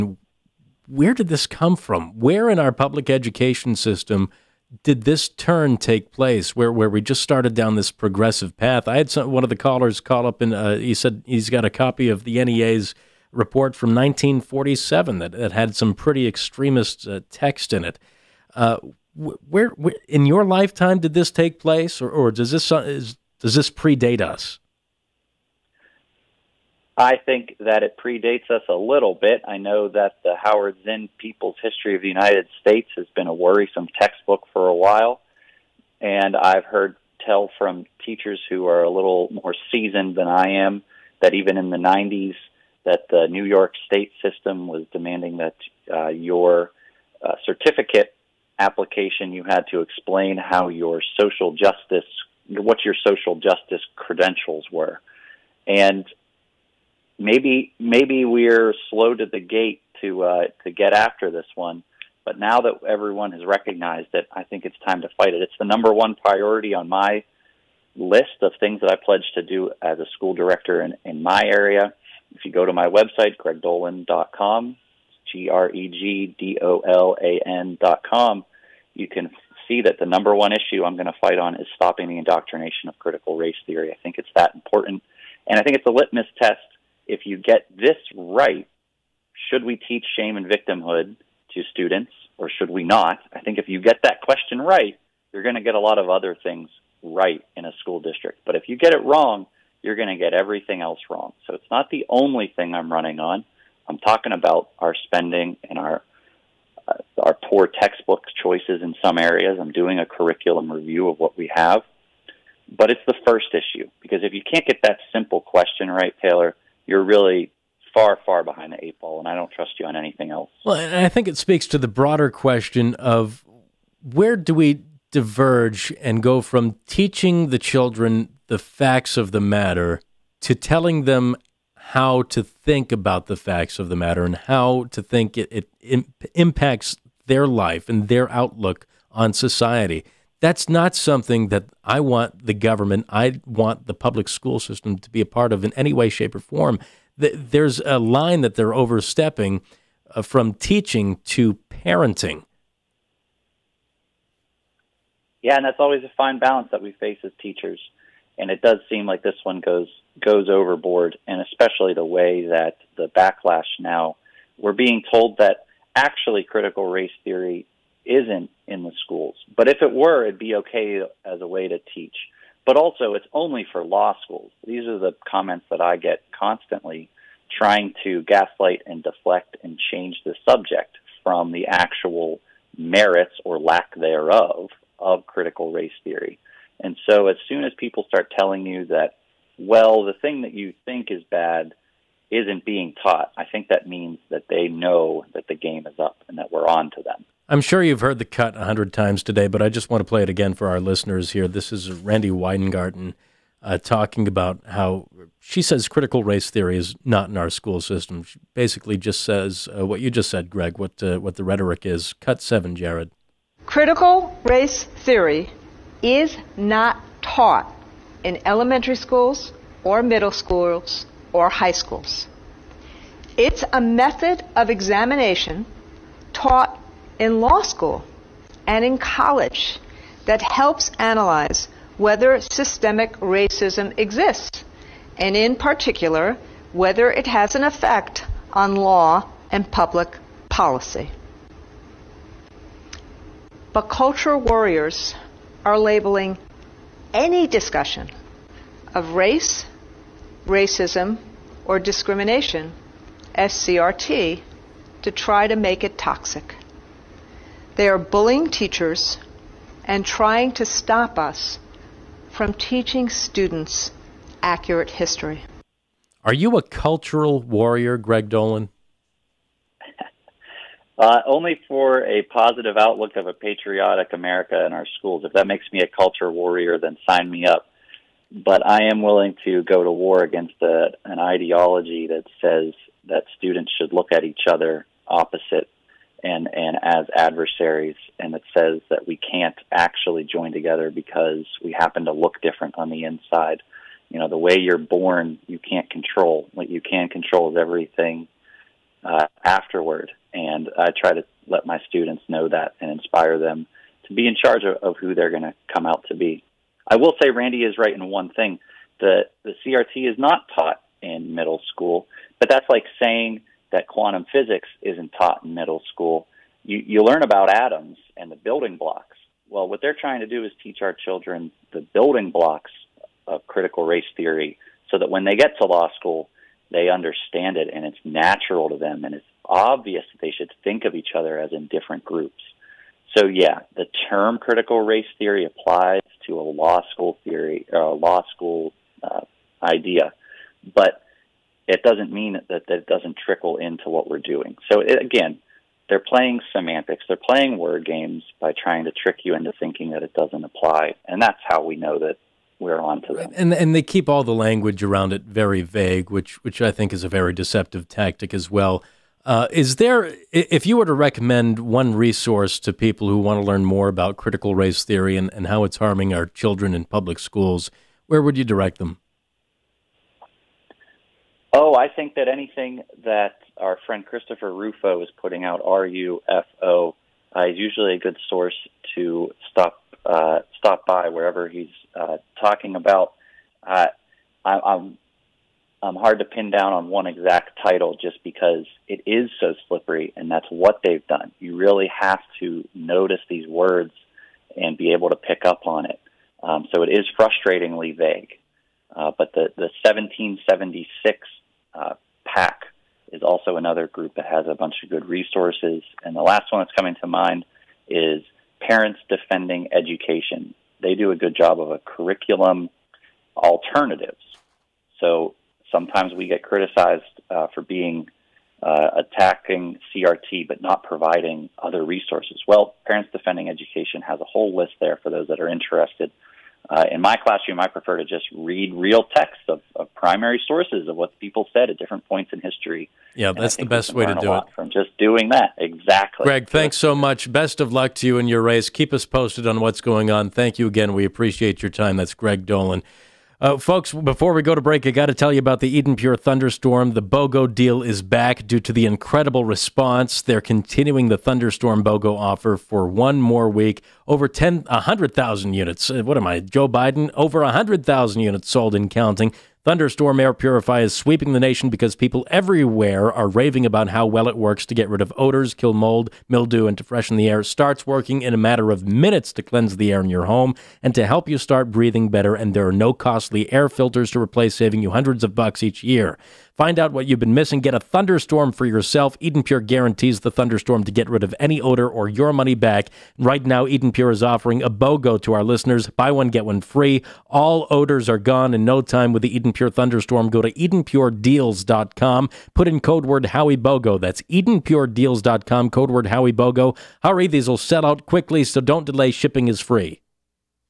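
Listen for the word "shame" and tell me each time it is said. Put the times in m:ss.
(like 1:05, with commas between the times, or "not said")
1:30.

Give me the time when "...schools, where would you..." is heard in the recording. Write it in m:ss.
6:07.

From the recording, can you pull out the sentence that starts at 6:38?
Uh, but the the 1776 uh, PAC is also another group that has a bunch of good resources.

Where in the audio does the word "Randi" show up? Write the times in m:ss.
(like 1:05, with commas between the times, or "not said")
3:21, 5:07.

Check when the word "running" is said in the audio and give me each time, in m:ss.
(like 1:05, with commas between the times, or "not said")
1:42.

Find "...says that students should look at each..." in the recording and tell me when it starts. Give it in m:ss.
4:42.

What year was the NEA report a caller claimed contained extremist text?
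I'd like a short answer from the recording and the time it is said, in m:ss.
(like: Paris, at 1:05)
1947, at 0:13.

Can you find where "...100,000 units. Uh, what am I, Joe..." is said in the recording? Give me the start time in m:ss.
7:34.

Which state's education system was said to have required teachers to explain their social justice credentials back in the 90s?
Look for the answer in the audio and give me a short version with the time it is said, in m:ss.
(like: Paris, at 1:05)
New York, at 0:43.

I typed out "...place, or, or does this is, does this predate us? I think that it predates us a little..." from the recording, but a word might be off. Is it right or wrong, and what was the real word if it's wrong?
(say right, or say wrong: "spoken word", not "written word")
right.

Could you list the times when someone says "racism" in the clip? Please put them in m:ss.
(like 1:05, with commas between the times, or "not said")
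3:53, 4:10.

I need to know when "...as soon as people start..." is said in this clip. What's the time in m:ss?
3:07.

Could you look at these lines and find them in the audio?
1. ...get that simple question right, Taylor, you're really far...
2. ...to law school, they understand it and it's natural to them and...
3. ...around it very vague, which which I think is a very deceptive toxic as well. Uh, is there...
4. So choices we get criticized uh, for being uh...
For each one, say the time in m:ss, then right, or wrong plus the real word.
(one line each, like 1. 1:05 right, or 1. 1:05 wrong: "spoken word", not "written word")
1. 1:54 right
2. 5:25 right
3. 5:54 wrong: "tactic", not "toxic"
4. 6:54 wrong: "sometimes", not "choices".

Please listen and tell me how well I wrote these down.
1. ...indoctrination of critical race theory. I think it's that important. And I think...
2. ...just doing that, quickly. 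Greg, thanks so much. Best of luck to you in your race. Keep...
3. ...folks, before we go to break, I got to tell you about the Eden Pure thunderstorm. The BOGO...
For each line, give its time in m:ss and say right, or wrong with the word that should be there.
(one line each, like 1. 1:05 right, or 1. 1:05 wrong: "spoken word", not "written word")
1. 1:22 right
2. 7:14 wrong: "exactly", not "quickly"
3. 7:23 right.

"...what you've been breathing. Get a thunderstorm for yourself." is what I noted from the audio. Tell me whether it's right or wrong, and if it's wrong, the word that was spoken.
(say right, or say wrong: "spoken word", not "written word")
wrong: "missing", not "breathing".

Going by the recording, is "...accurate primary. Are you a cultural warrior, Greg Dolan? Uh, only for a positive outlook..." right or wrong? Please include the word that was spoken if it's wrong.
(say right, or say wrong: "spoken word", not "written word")
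wrong: "history", not "primary".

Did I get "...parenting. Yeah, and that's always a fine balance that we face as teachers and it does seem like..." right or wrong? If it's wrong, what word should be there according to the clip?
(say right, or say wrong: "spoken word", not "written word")
right.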